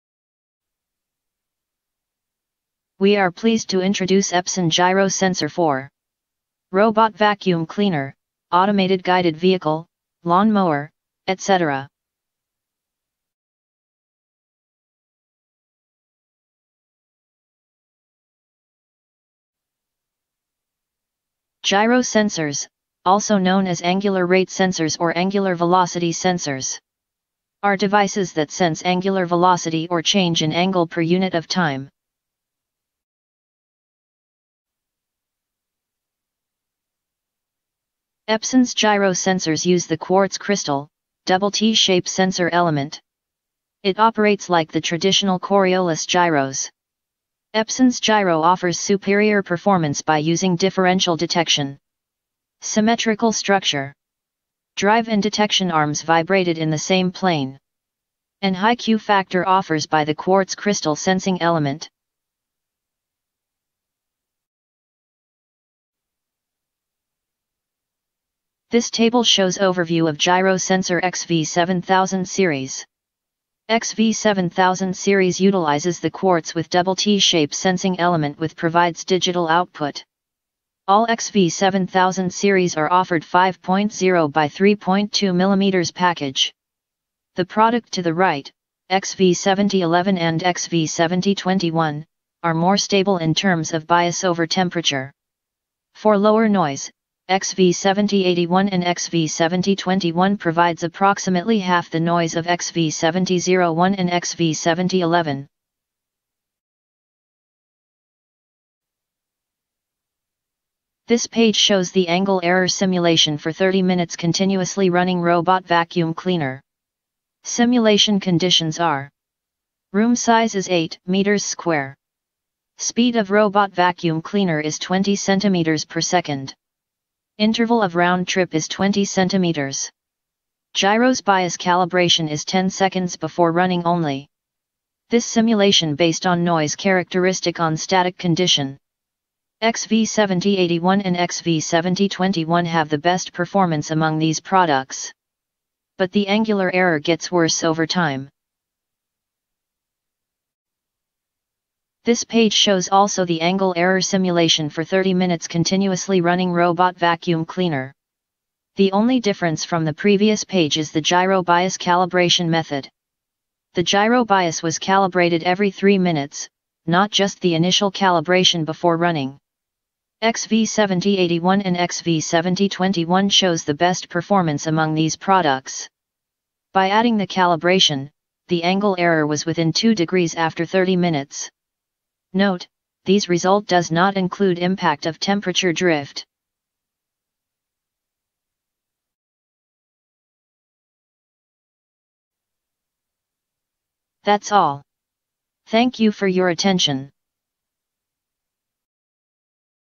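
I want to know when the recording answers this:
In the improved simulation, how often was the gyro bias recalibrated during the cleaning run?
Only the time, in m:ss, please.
2:45.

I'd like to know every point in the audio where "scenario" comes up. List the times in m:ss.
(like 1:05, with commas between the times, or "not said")
not said.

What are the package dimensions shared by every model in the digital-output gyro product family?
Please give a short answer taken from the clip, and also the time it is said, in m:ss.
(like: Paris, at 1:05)
5.0 by 3.2 mm, at 1:23.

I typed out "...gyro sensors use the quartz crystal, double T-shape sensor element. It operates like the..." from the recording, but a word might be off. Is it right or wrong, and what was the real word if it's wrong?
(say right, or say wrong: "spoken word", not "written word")
right.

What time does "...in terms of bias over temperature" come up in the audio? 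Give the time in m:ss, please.
1:33.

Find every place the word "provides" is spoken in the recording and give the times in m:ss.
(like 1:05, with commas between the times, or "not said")
1:18, 1:40.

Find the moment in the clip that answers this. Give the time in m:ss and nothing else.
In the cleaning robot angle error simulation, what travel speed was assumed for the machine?
2:04.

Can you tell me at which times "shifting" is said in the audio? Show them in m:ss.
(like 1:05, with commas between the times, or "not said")
not said.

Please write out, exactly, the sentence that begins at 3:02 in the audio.
Note, these result does not include impact of temperature drift.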